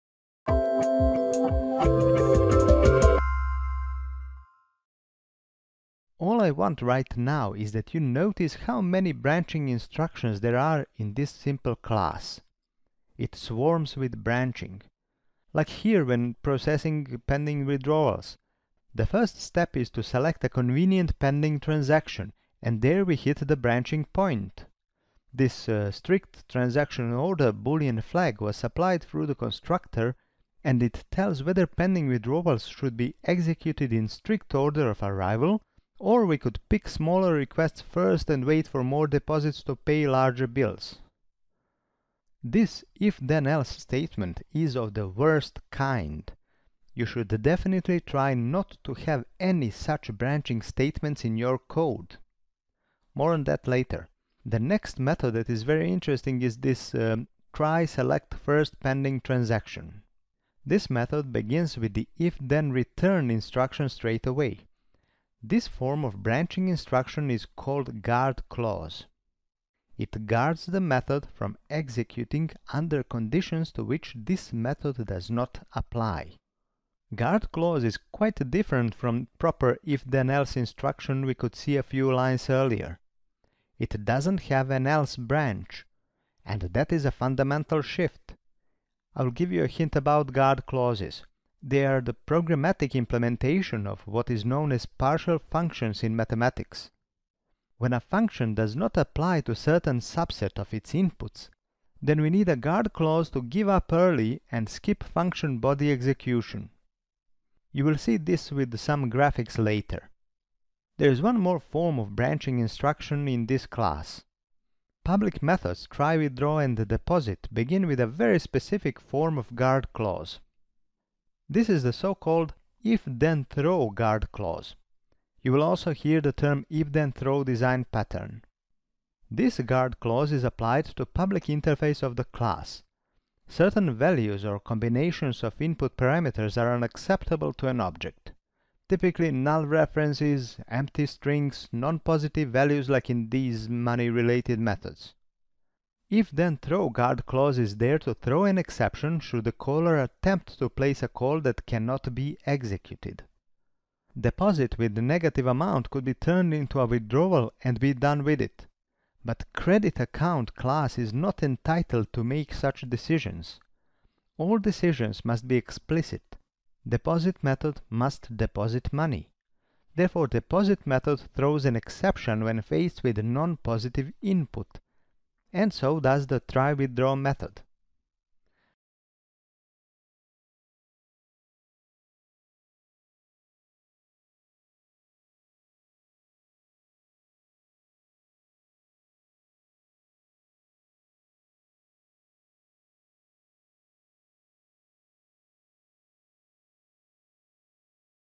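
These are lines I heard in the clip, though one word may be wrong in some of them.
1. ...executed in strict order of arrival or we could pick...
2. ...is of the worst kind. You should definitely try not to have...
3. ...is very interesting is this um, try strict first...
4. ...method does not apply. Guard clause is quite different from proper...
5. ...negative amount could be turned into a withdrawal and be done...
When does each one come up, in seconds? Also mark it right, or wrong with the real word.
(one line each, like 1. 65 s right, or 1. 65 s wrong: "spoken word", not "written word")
1. 33 s right
2. 44 s right
3. 55 s wrong: "select", not "strict"
4. 74 s right
5. 155 s right.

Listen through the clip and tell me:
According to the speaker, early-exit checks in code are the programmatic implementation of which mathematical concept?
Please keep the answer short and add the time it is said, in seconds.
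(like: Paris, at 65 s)
partial functions, at 94 s.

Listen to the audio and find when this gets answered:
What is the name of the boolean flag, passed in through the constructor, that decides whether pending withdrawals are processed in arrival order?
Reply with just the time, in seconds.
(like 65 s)
25 s.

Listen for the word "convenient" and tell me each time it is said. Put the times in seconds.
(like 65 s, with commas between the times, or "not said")
20 s.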